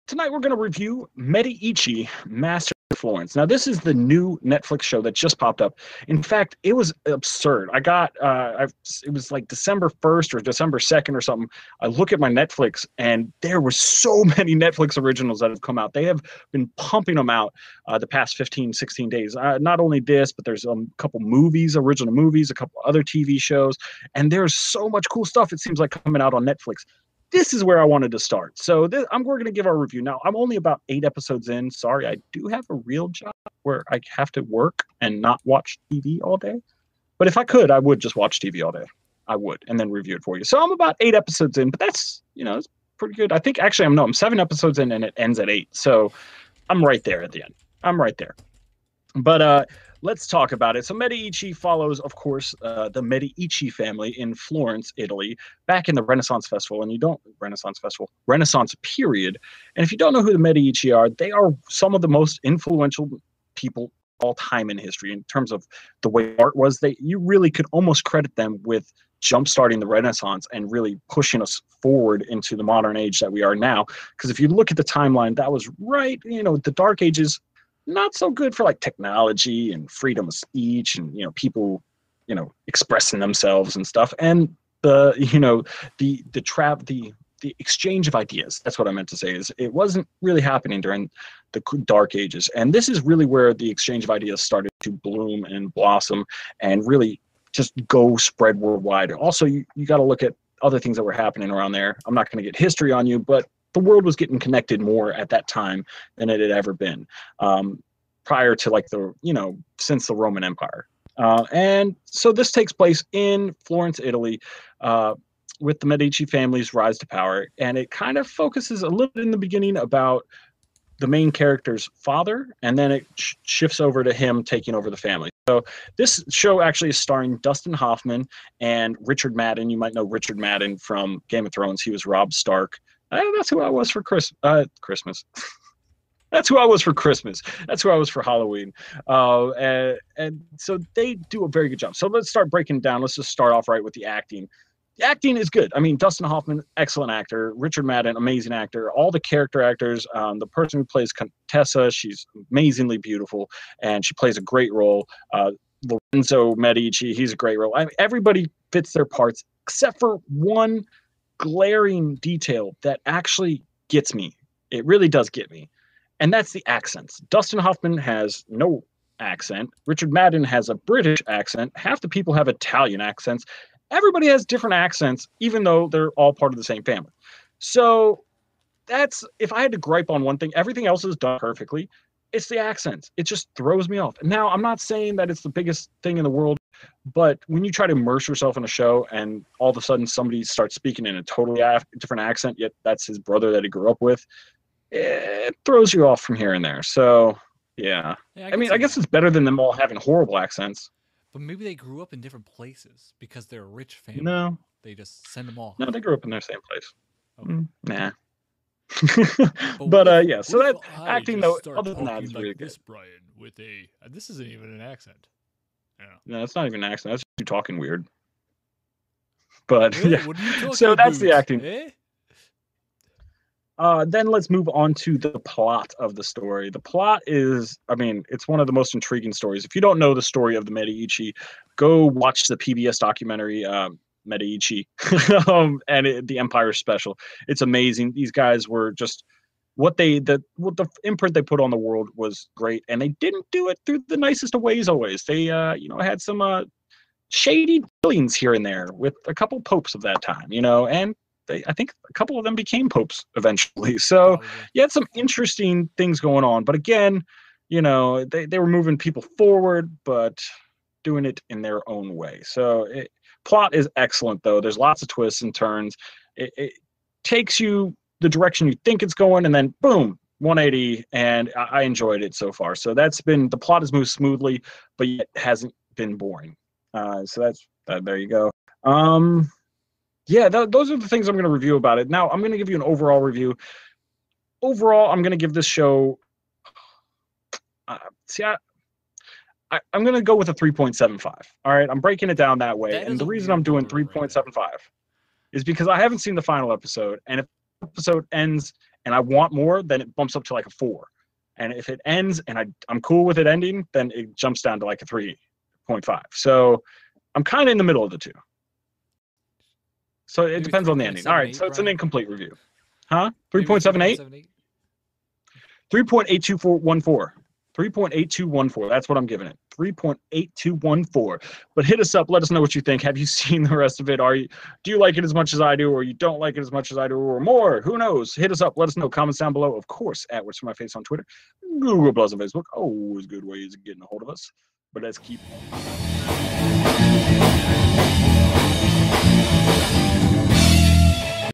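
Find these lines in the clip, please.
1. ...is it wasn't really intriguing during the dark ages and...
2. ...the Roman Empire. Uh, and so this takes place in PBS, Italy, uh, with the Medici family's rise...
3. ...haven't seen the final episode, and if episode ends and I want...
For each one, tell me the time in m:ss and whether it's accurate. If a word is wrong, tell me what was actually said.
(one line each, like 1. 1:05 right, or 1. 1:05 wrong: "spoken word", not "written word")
1. 1:29 wrong: "happening", not "intriguing"
2. 1:50 wrong: "Florence", not "PBS"
3. 4:55 right.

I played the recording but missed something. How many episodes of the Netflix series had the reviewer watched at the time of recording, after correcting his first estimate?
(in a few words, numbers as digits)
7.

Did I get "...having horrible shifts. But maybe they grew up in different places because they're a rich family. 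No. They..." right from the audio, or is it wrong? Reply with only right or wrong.
wrong.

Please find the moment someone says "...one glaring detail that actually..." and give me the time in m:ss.
2:40.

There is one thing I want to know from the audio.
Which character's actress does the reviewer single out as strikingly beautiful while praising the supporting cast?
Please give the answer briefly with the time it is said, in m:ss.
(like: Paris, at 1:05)
Contessa, at 2:31.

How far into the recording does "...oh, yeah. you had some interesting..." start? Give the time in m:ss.
4:14.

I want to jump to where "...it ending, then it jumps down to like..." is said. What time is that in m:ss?
5:03.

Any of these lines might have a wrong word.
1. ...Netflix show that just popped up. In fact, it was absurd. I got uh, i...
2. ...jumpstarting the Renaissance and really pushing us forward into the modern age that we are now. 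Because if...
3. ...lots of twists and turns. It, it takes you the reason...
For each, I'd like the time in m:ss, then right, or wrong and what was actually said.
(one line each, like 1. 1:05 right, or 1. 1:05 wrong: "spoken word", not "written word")
1. 0:04 right
2. 1:09 right
3. 4:24 wrong: "direction", not "reason".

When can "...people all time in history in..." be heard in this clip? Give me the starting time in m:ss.
1:03.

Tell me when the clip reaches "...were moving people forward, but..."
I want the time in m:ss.
4:18.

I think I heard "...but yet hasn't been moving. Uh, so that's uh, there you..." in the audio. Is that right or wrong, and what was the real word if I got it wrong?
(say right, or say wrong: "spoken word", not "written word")
wrong: "boring", not "moving".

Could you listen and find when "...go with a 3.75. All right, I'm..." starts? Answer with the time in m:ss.
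4:50.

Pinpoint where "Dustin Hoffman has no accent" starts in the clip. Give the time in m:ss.
2:47.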